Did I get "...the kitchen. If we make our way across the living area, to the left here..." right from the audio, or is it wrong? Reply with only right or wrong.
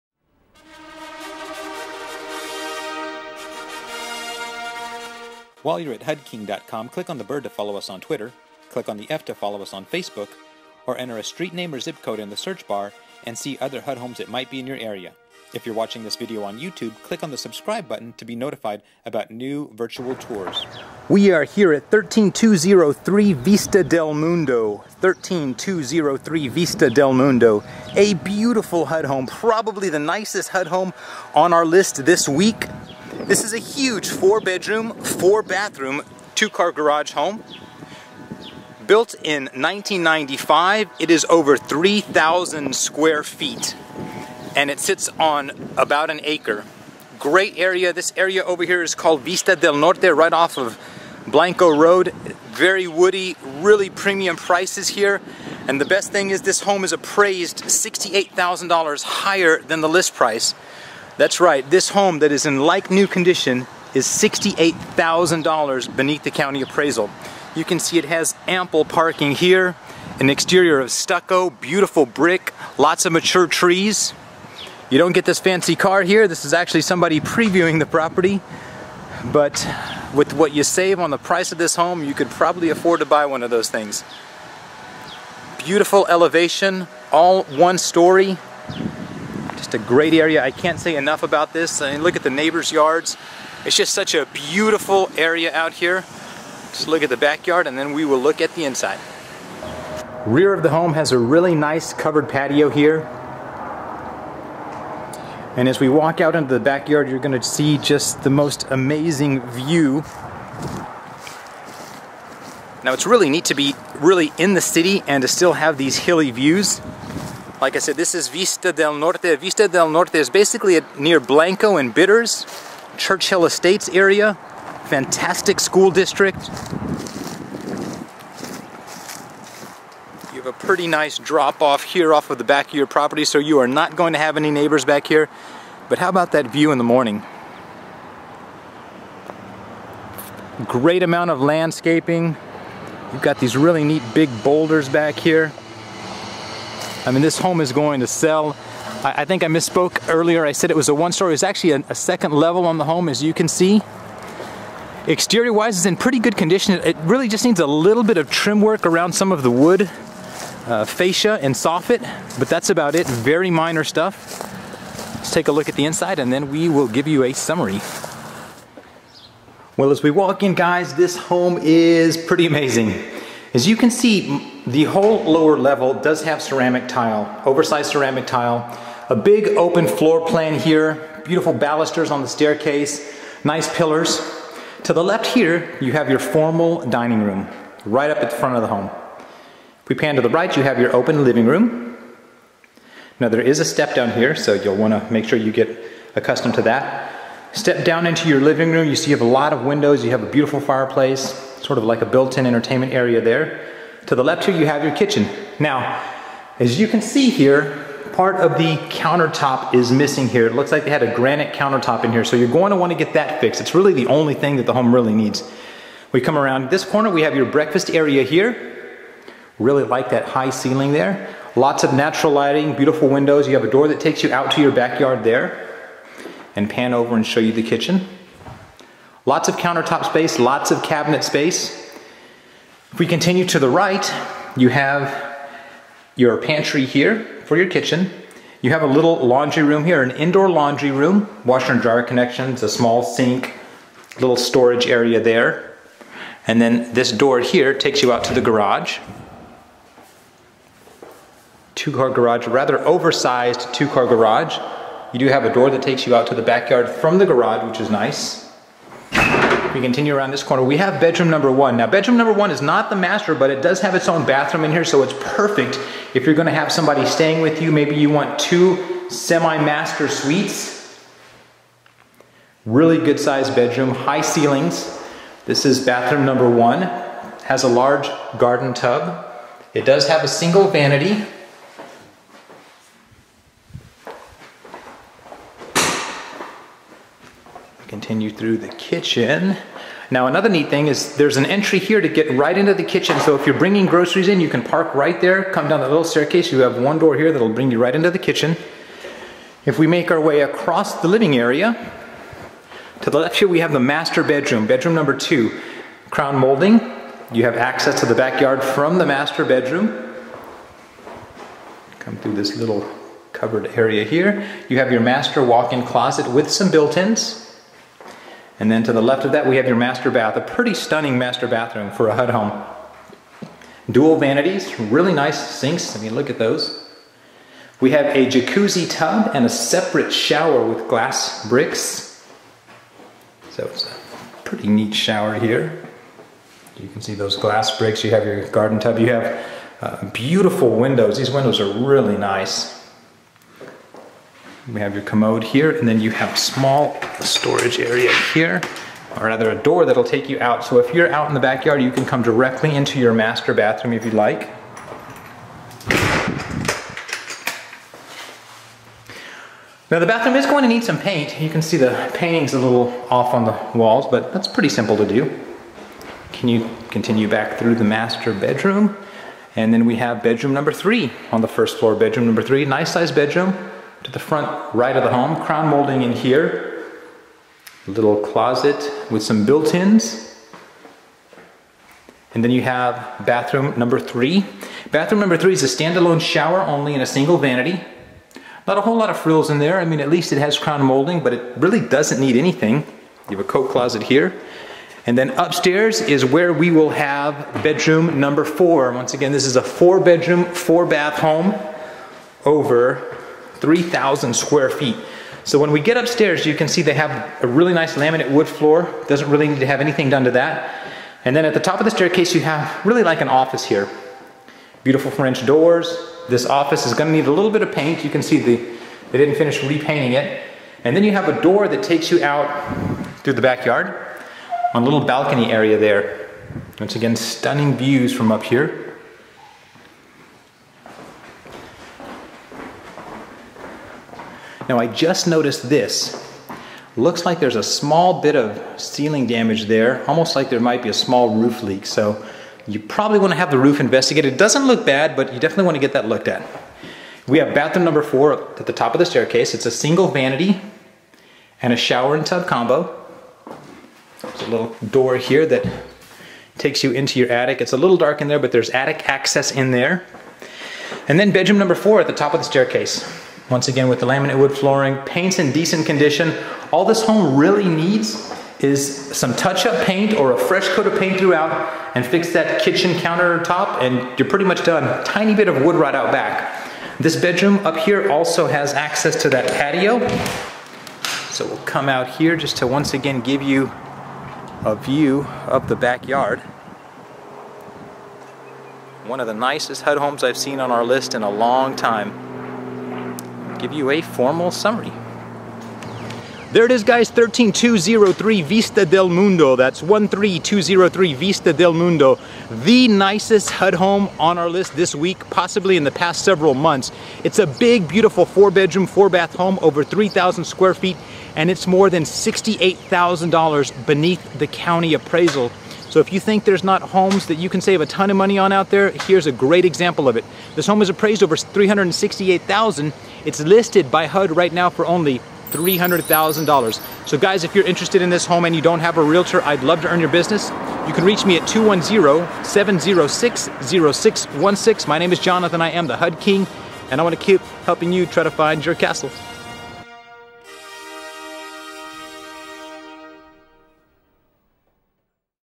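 right.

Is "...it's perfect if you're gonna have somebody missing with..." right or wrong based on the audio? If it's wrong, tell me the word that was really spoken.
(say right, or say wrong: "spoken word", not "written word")
wrong: "staying", not "missing".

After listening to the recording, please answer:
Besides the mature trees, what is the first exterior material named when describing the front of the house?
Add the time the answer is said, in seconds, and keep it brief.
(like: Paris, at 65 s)
Stucco, at 70 s.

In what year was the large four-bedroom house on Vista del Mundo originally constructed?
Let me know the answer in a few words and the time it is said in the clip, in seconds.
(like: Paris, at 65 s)
1995, at 38 s.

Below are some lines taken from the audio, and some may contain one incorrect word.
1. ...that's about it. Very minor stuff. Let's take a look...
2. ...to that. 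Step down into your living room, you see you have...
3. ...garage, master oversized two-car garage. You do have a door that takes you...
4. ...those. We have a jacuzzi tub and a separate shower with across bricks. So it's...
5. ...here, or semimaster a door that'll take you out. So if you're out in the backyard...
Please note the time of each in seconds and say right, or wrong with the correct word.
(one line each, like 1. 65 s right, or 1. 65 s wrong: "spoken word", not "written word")
1. 162 s right
2. 196 s right
3. 252 s wrong: "rather", not "master"
4. 326 s wrong: "glass", not "across"
5. 348 s wrong: "rather", not "semimaster".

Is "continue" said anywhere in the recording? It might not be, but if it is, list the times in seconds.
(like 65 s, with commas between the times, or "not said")
233 s, 259 s, 366 s.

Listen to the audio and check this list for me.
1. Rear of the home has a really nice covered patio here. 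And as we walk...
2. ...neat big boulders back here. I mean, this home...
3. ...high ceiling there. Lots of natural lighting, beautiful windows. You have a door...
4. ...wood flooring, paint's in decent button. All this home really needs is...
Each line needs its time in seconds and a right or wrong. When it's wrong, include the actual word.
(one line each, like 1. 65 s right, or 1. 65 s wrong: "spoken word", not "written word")
1. 100 s right
2. 143 s right
3. 220 s right
4. 464 s wrong: "condition", not "button".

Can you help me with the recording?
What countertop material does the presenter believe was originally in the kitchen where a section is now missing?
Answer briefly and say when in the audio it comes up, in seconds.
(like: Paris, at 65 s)
Granite, at 211 s.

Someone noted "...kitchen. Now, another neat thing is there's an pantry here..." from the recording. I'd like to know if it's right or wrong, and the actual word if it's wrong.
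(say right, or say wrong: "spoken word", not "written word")
wrong: "entry", not "pantry".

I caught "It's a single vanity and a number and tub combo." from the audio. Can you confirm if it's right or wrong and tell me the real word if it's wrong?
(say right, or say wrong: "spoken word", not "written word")
wrong: "shower", not "number".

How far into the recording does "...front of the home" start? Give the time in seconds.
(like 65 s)
188 s.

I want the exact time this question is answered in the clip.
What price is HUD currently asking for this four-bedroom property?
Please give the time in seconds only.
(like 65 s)
525 s.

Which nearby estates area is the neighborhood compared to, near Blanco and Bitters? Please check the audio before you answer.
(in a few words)
Churchill Estates.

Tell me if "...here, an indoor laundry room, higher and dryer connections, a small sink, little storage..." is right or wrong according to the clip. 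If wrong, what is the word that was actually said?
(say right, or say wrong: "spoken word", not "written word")
wrong: "washer", not "higher".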